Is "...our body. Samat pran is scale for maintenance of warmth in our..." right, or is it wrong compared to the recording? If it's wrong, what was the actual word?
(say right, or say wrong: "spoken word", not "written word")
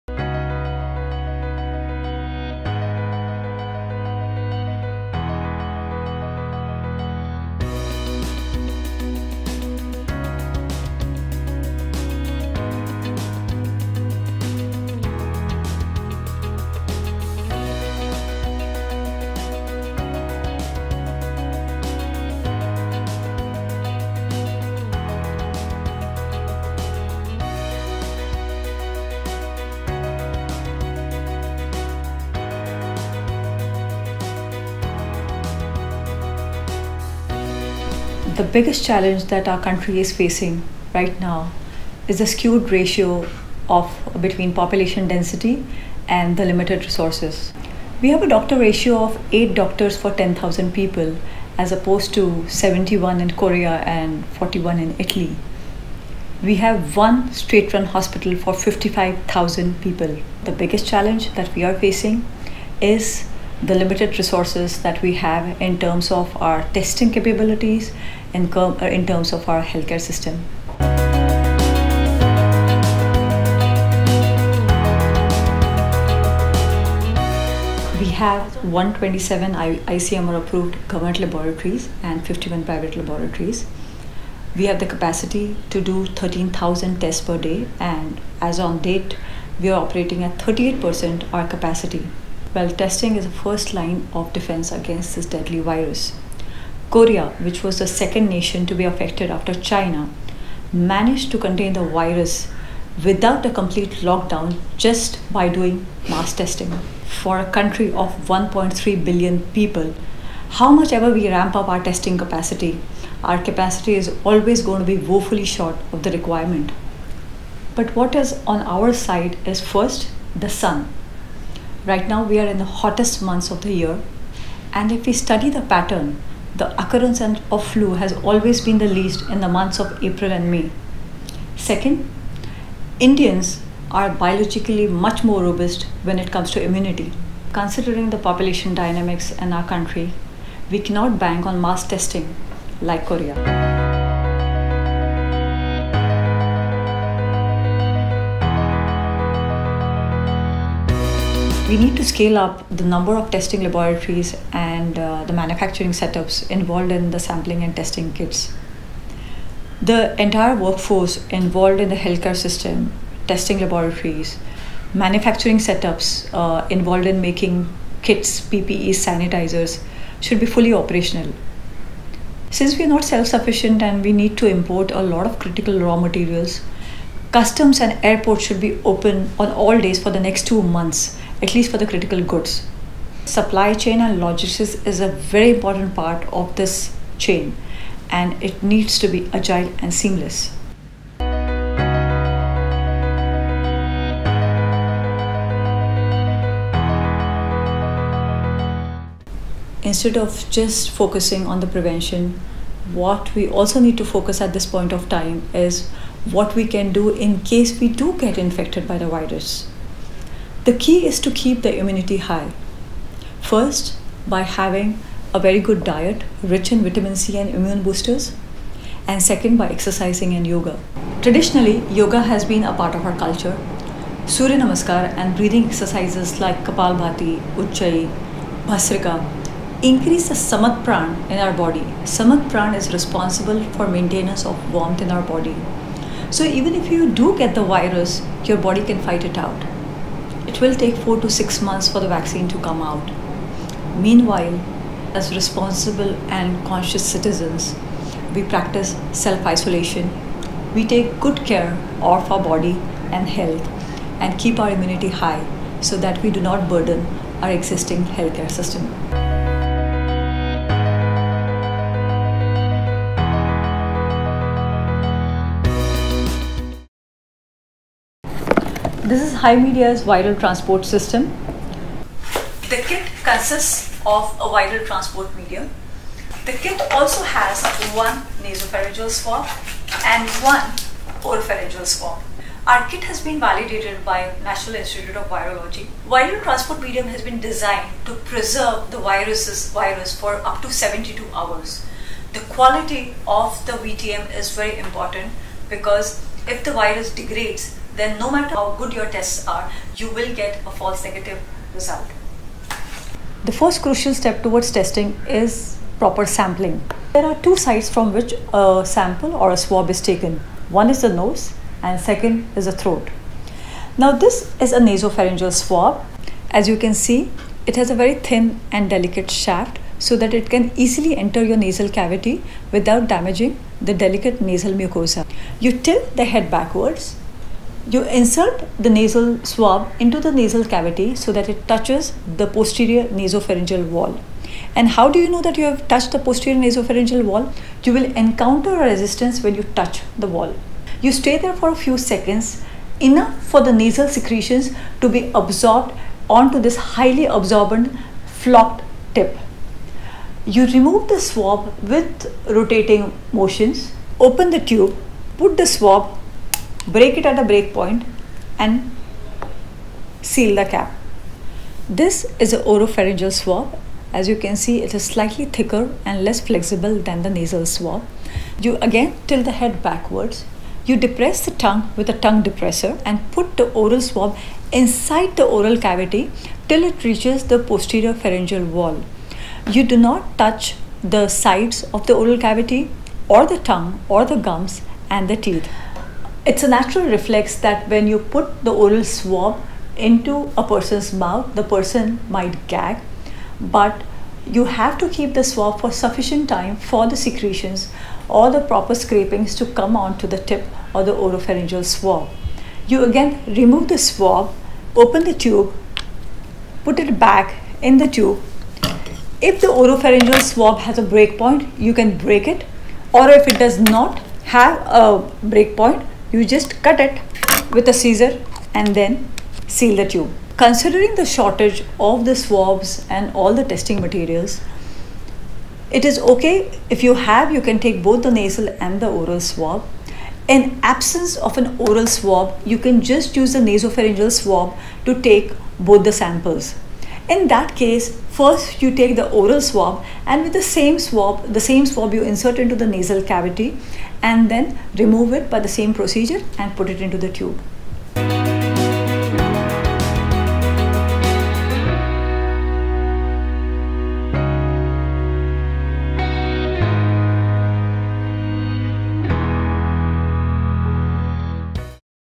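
wrong: "responsible", not "scale".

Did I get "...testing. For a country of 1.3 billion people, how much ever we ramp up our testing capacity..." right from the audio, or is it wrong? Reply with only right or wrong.
right.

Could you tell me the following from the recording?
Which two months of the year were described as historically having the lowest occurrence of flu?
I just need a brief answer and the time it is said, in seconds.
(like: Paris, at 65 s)
April and May, at 130 s.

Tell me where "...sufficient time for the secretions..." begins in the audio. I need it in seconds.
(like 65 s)
395 s.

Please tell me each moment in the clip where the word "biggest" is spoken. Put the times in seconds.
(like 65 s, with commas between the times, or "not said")
38 s, 60 s.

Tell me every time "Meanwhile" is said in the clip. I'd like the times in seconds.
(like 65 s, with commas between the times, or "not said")
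244 s.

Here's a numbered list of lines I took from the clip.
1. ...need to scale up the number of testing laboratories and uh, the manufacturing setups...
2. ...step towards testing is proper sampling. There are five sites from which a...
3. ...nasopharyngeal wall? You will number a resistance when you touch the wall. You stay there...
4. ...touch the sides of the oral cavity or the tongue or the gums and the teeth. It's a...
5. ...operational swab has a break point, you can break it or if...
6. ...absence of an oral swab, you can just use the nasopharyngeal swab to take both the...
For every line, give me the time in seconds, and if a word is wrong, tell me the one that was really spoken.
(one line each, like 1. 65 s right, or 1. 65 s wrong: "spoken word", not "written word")
1. 151 s right
2. 304 s wrong: "two", not "five"
3. 336 s wrong: "encounter", not "number"
4. 380 s right
5. 409 s wrong: "oropharyngeal", not "operational"
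6. 430 s right.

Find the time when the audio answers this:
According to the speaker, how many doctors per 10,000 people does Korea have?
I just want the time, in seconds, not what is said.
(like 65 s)
52 s.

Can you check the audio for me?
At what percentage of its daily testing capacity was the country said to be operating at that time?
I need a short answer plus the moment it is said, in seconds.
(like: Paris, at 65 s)
38%, at 90 s.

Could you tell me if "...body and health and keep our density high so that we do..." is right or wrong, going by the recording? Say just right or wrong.
wrong.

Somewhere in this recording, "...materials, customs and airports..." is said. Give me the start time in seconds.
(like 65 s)
175 s.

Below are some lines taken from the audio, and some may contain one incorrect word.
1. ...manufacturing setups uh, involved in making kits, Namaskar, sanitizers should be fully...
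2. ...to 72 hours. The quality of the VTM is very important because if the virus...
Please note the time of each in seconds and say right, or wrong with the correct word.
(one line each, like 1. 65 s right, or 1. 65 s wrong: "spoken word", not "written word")
1. 164 s wrong: "PPE", not "Namaskar"
2. 290 s right.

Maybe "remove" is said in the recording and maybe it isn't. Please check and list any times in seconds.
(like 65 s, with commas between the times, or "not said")
350 s, 403 s, 444 s.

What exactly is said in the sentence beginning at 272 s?
The kit consists of a viral transport medium.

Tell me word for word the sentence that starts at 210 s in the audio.
The key is to keep the immunity high.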